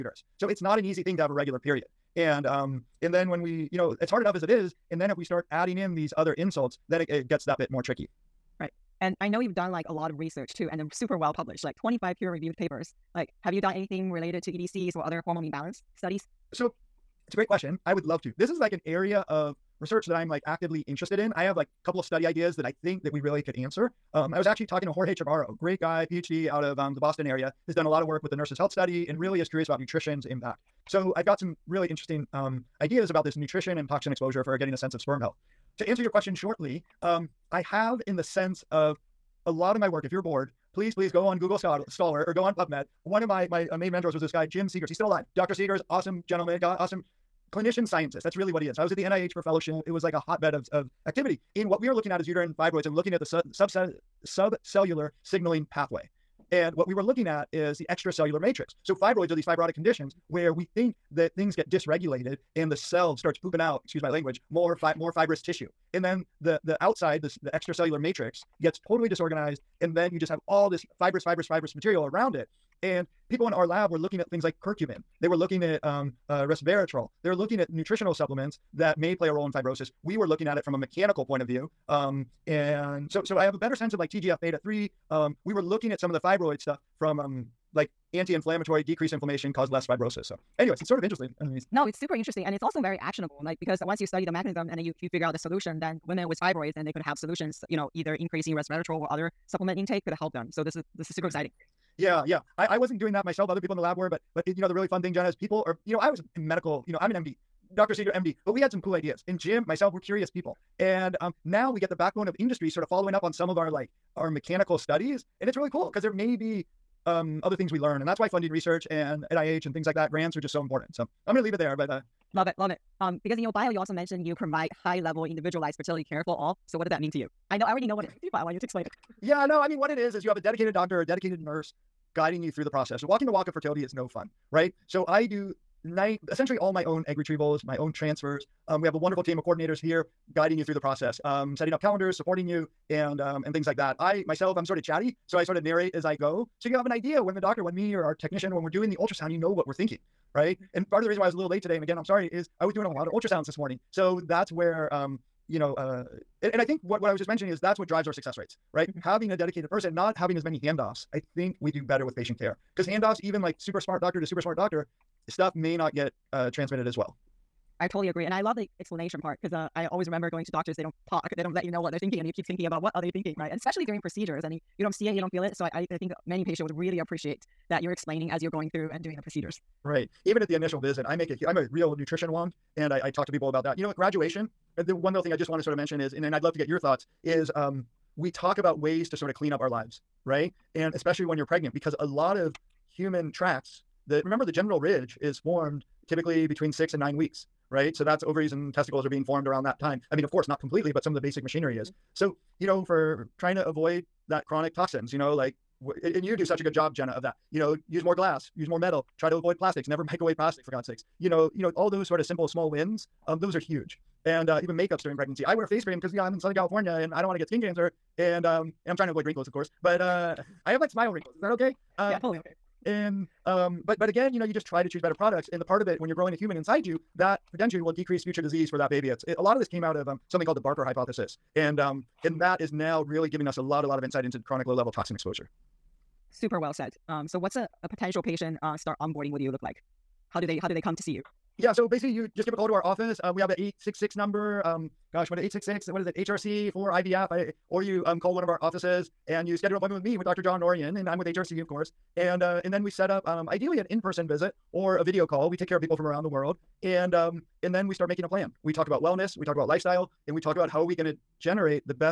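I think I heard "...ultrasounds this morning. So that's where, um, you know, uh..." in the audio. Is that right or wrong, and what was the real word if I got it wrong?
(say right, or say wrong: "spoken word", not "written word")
right.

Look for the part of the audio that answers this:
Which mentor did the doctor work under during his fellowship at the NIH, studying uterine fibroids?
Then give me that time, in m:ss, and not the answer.
0:44.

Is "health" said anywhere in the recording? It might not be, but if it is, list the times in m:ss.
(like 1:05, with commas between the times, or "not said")
0:28, 0:35.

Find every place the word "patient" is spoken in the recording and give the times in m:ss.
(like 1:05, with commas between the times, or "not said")
2:42, 2:56, 3:58.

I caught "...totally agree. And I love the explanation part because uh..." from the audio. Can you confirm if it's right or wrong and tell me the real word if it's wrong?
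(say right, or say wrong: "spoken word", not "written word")
right.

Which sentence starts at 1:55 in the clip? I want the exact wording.
And it's really cool because there may be um, other things we learn.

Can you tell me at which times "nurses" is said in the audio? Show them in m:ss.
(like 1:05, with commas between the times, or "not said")
0:28, 2:11.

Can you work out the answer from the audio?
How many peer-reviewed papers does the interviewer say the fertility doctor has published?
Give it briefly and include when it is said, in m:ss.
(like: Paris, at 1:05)
25, at 0:11.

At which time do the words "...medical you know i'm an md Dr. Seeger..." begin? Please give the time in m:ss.
1:46.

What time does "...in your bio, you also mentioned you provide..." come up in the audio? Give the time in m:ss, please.
2:03.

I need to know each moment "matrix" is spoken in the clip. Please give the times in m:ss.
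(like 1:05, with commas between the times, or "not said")
0:58, 1:07.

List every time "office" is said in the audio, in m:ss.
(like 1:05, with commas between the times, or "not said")
4:02, 4:08.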